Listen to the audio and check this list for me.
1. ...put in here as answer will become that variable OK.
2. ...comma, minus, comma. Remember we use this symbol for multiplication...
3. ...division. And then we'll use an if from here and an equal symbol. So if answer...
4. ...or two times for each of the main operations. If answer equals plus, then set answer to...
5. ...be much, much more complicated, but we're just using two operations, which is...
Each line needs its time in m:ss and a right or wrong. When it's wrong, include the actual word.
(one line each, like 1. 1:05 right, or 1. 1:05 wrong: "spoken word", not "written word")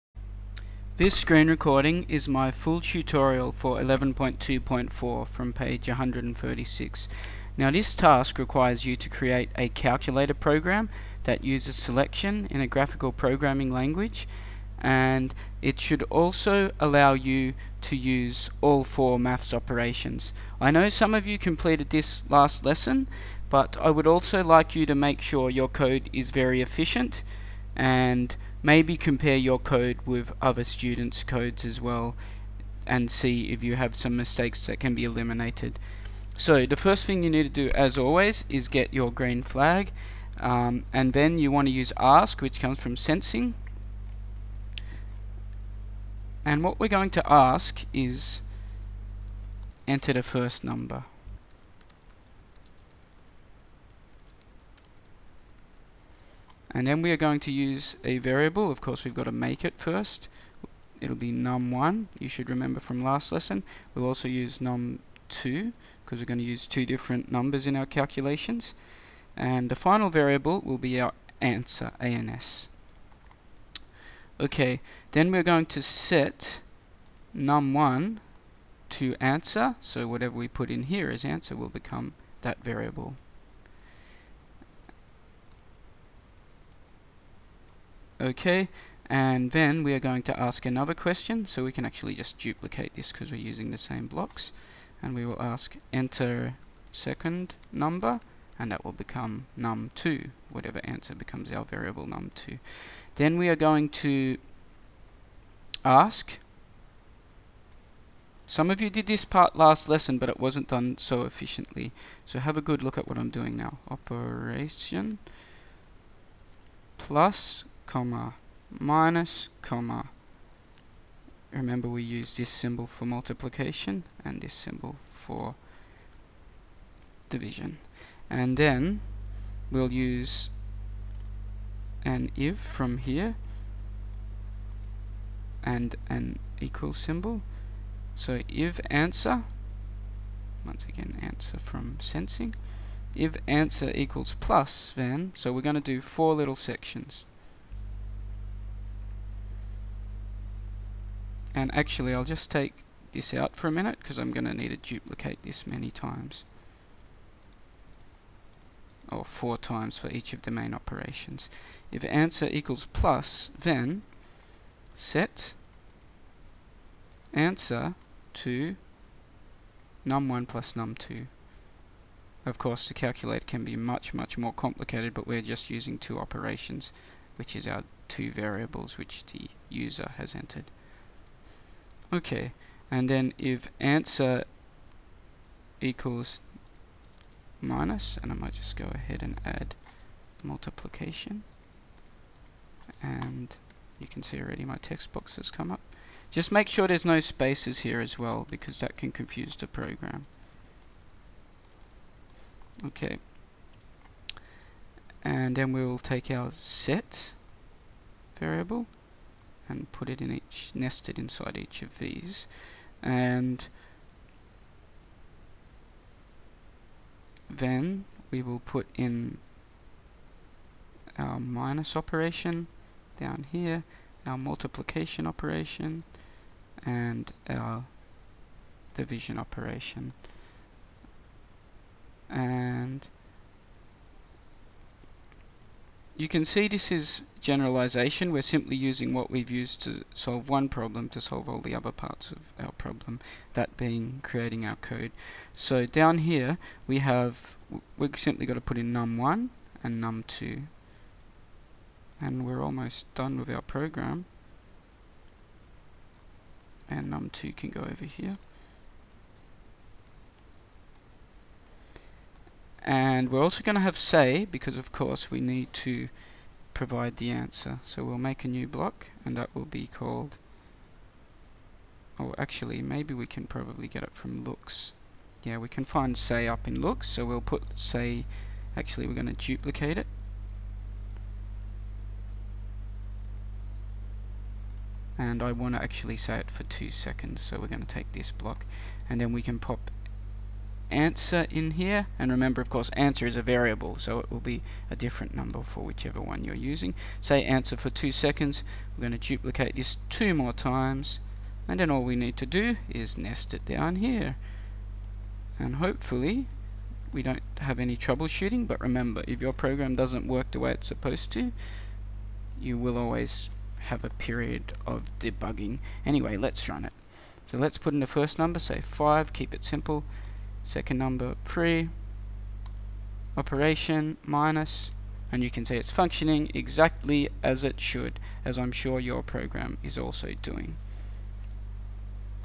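1. 1:20 right
2. 1:57 right
3. 2:07 right
4. 2:39 wrong: "four", not "two"
5. 2:53 right.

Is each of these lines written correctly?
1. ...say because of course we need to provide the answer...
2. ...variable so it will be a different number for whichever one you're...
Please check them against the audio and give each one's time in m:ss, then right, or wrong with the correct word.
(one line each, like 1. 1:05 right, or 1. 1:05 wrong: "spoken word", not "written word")
1. 4:23 right
2. 4:53 right.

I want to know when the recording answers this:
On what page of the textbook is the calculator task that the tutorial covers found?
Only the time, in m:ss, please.
0:05.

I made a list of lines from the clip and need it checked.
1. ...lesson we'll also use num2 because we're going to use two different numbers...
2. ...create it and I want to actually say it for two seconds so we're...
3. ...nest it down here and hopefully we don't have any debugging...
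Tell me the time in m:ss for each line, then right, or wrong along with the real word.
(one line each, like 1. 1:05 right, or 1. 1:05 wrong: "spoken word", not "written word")
1. 1:03 right
2. 4:39 wrong: "duplicate", not "create"
3. 5:03 wrong: "troubleshooting", not "debugging".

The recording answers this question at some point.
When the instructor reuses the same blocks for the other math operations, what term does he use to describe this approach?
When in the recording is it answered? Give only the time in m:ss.
3:57.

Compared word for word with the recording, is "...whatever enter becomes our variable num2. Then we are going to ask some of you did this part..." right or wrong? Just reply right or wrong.
wrong.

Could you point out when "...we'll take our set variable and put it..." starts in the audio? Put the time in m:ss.
3:25.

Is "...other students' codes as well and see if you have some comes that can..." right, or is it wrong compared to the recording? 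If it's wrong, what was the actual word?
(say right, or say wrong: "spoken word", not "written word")
wrong: "mistakes", not "comes".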